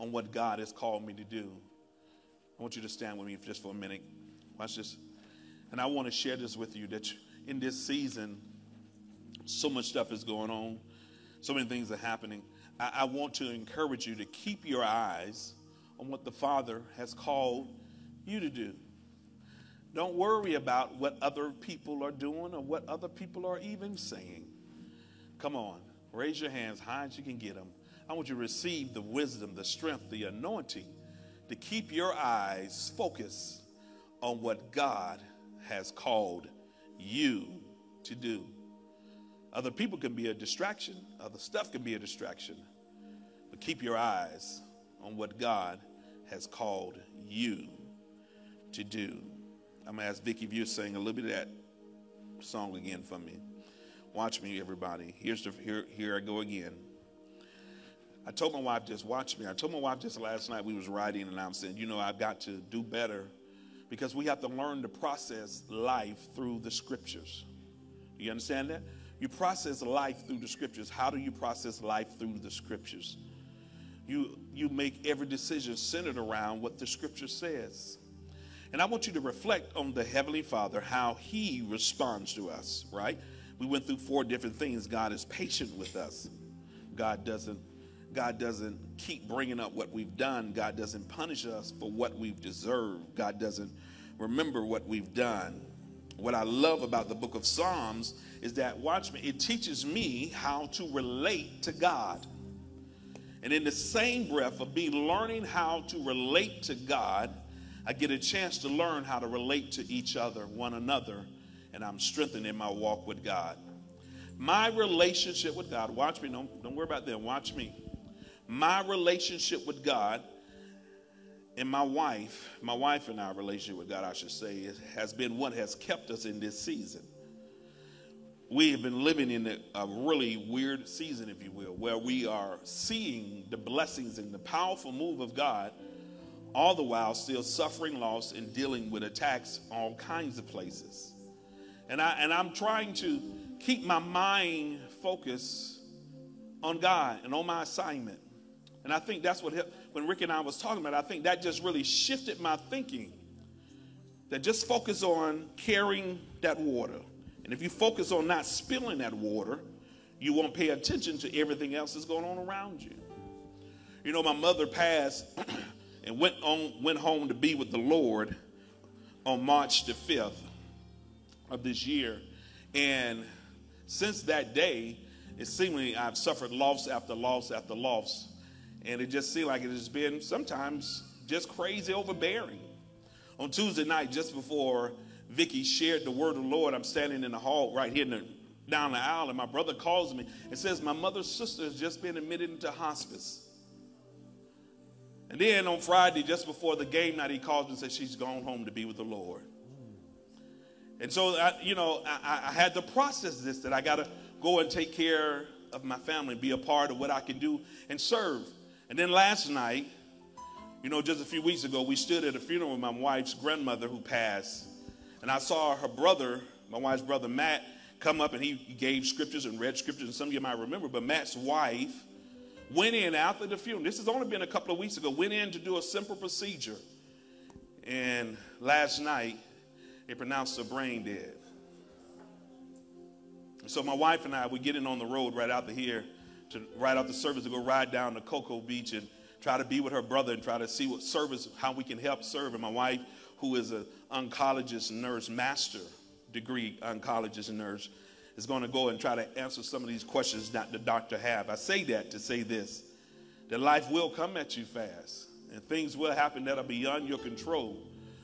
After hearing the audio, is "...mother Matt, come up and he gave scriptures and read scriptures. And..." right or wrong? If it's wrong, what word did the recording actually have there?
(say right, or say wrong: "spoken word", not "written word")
wrong: "brother", not "mother".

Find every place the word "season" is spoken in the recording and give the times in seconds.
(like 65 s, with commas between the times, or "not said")
7 s, 126 s, 130 s.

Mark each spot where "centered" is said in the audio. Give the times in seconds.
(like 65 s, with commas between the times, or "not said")
75 s.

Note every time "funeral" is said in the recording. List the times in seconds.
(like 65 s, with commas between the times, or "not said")
212 s, 223 s.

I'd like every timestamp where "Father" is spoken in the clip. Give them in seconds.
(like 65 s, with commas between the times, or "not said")
16 s, 80 s.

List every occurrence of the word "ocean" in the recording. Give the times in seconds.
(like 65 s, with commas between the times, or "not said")
not said.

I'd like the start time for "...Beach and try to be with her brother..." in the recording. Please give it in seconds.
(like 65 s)
238 s.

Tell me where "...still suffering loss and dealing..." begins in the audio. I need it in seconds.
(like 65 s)
137 s.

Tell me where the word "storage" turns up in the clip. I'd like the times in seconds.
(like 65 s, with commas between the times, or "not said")
not said.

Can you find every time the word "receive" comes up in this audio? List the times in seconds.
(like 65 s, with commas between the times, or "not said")
28 s.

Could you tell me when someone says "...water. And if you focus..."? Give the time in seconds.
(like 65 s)
156 s.